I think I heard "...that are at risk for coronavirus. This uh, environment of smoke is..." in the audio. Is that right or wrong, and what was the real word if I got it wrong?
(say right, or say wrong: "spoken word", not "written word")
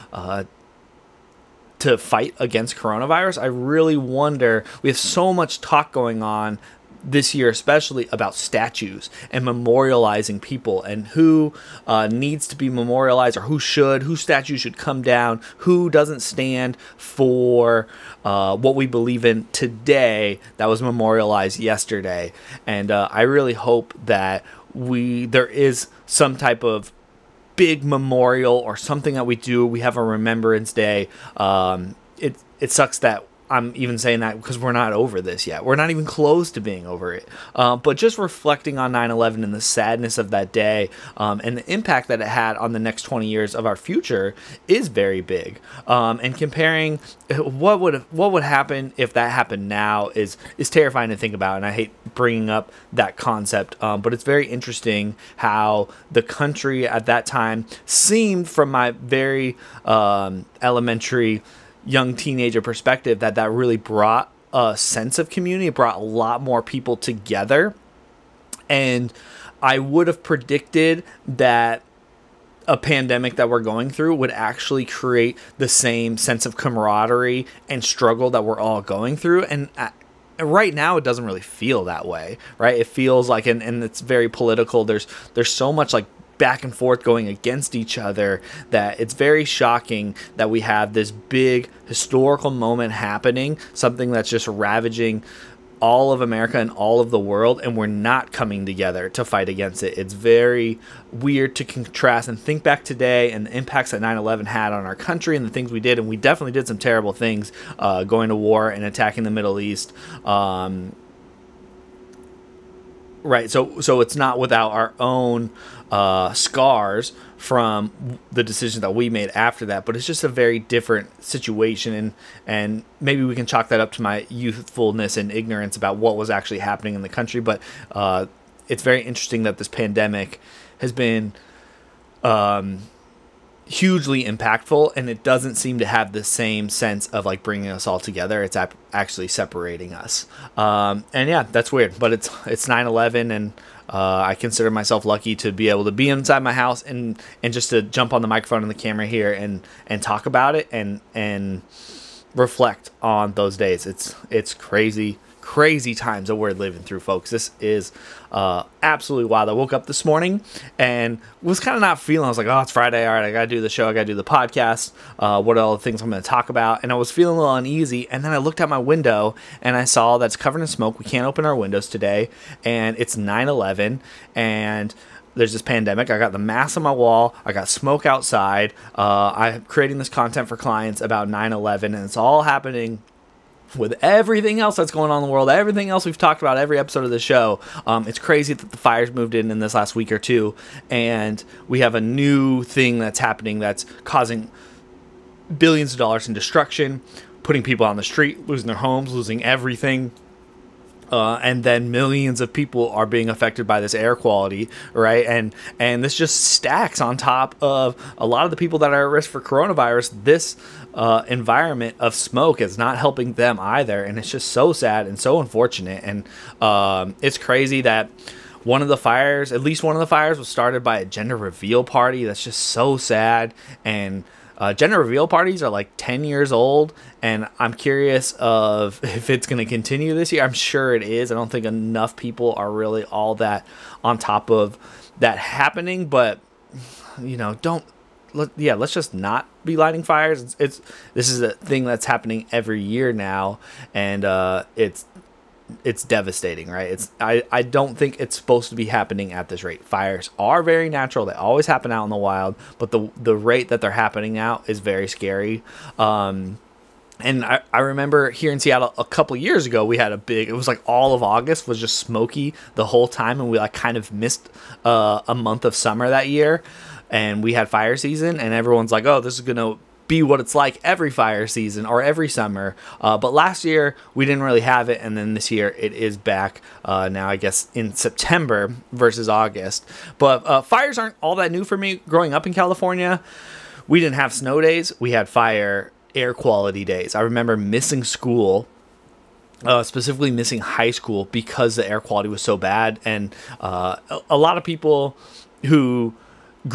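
right.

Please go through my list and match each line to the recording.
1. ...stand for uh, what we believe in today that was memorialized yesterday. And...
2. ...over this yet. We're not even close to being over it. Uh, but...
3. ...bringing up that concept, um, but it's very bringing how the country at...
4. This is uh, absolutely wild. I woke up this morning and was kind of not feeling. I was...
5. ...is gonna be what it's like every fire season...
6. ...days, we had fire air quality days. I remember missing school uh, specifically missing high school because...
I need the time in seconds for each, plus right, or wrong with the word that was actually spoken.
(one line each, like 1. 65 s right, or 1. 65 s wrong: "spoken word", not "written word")
1. 16 s right
2. 34 s right
3. 52 s wrong: "interesting", not "bringing"
4. 157 s right
5. 269 s right
6. 284 s right.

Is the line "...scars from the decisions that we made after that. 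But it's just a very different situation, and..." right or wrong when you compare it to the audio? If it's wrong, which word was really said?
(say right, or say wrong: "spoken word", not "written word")
right.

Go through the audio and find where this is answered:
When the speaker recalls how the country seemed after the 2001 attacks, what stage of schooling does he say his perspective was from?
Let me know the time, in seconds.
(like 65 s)
60 s.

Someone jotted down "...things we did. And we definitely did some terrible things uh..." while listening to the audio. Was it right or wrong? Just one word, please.
right.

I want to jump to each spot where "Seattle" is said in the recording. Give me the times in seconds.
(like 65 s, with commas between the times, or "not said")
258 s.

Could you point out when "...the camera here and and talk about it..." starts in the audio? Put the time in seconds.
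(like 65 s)
148 s.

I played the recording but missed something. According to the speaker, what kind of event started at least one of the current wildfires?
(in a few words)
gender reveal party.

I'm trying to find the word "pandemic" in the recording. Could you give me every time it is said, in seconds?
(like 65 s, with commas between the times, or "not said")
72 s, 129 s, 175 s.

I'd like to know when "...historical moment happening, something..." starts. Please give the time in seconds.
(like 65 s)
91 s.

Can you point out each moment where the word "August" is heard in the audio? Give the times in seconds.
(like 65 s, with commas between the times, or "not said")
261 s, 279 s.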